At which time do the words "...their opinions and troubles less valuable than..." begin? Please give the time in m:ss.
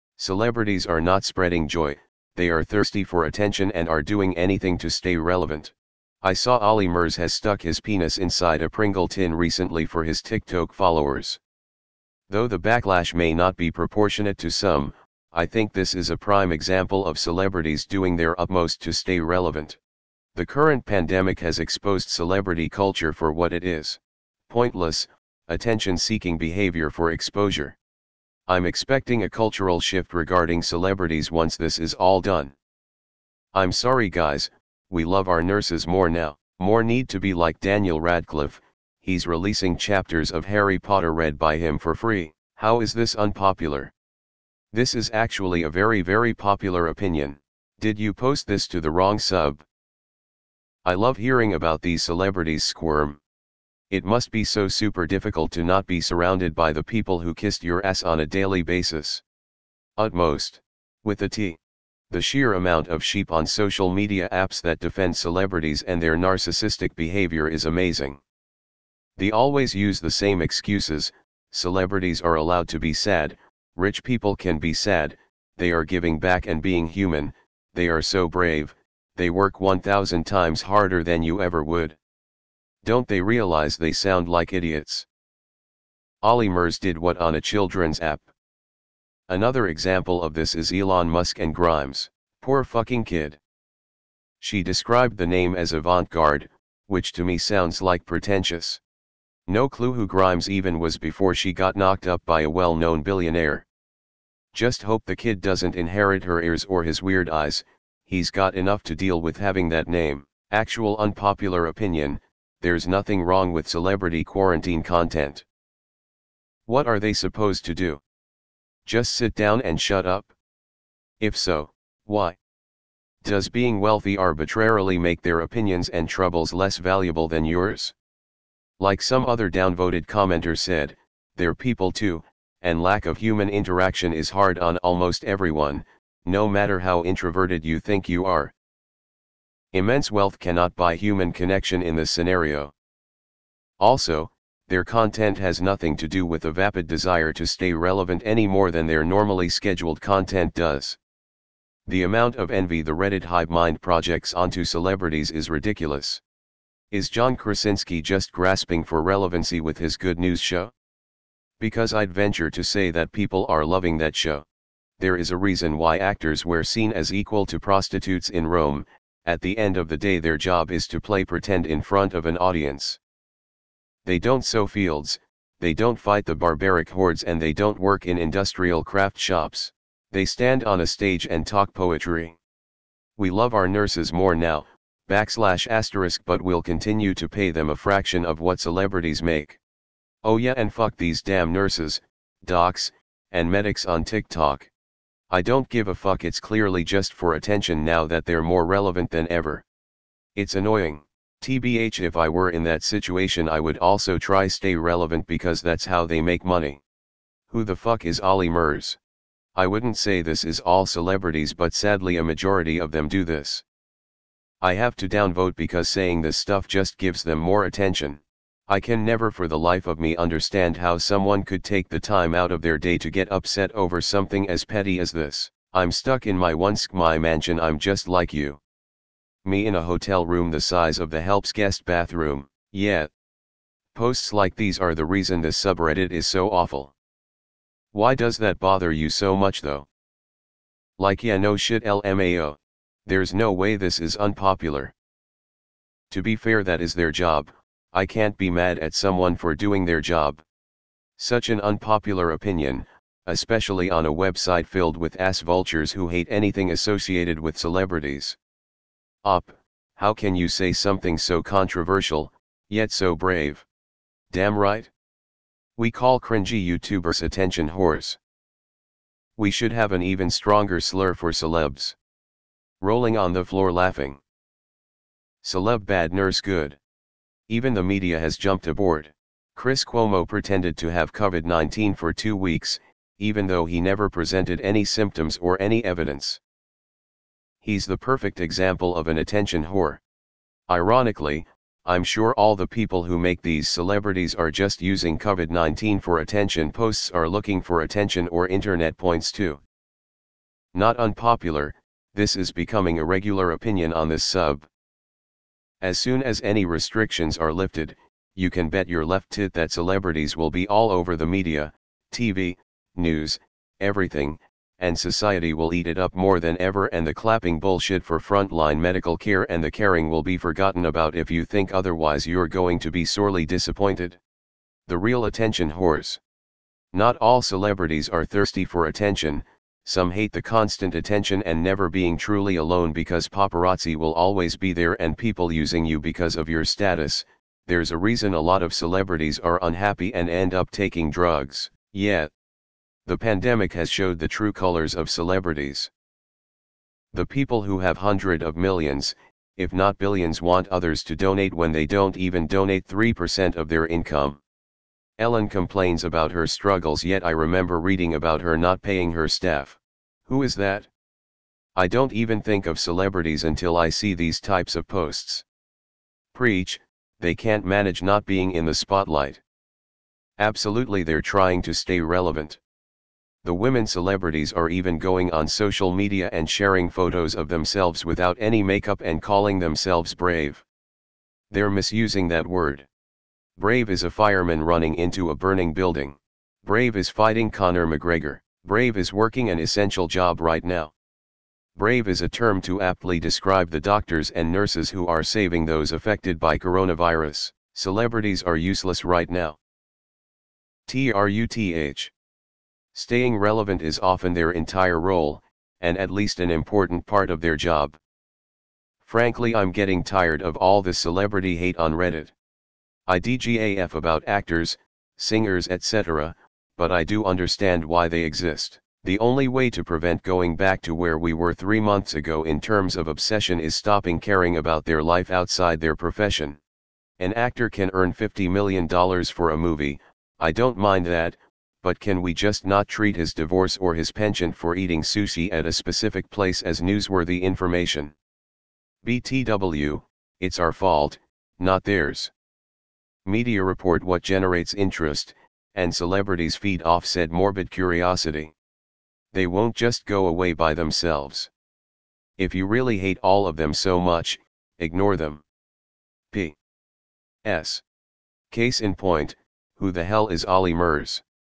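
2:05.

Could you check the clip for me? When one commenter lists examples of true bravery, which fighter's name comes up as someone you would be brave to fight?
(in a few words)
Conor McGregor.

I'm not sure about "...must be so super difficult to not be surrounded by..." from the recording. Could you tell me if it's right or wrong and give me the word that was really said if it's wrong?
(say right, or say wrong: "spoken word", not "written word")
right.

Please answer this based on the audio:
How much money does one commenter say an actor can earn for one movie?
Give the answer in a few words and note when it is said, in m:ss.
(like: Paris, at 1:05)
$50 million, at 7:08.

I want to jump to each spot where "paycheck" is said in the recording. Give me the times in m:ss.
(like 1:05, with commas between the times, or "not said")
not said.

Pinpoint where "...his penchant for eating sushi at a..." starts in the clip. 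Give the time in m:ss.
7:13.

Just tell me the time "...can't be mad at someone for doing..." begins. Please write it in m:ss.
4:08.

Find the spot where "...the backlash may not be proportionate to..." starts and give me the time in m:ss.
0:12.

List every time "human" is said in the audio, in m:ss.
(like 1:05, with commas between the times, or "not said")
1:16, 2:13, 2:20.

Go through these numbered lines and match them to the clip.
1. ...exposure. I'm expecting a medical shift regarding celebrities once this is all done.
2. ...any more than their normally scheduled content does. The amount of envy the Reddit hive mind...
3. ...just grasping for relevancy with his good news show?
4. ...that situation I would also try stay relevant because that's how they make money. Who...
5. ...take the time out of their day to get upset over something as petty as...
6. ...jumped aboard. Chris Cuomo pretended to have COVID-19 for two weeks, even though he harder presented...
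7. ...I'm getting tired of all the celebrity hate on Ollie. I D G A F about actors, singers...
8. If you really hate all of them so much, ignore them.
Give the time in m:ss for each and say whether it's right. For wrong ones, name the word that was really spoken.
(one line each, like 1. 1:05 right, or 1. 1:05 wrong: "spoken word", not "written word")
1. 0:27 wrong: "cultural", not "medical"
2. 2:28 right
3. 2:38 right
4. 3:22 right
5. 3:41 right
6. 4:38 wrong: "never", not "harder"
7. 6:49 wrong: "Reddit", not "Ollie"
8. 7:32 right.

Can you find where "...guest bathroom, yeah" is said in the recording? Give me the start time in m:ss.
3:51.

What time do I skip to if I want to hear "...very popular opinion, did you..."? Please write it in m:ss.
0:46.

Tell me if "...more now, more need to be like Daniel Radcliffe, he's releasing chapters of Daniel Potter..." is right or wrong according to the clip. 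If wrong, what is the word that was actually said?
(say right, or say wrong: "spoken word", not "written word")
wrong: "Harry", not "Daniel".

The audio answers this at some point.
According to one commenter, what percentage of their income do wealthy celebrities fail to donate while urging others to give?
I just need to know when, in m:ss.
5:52.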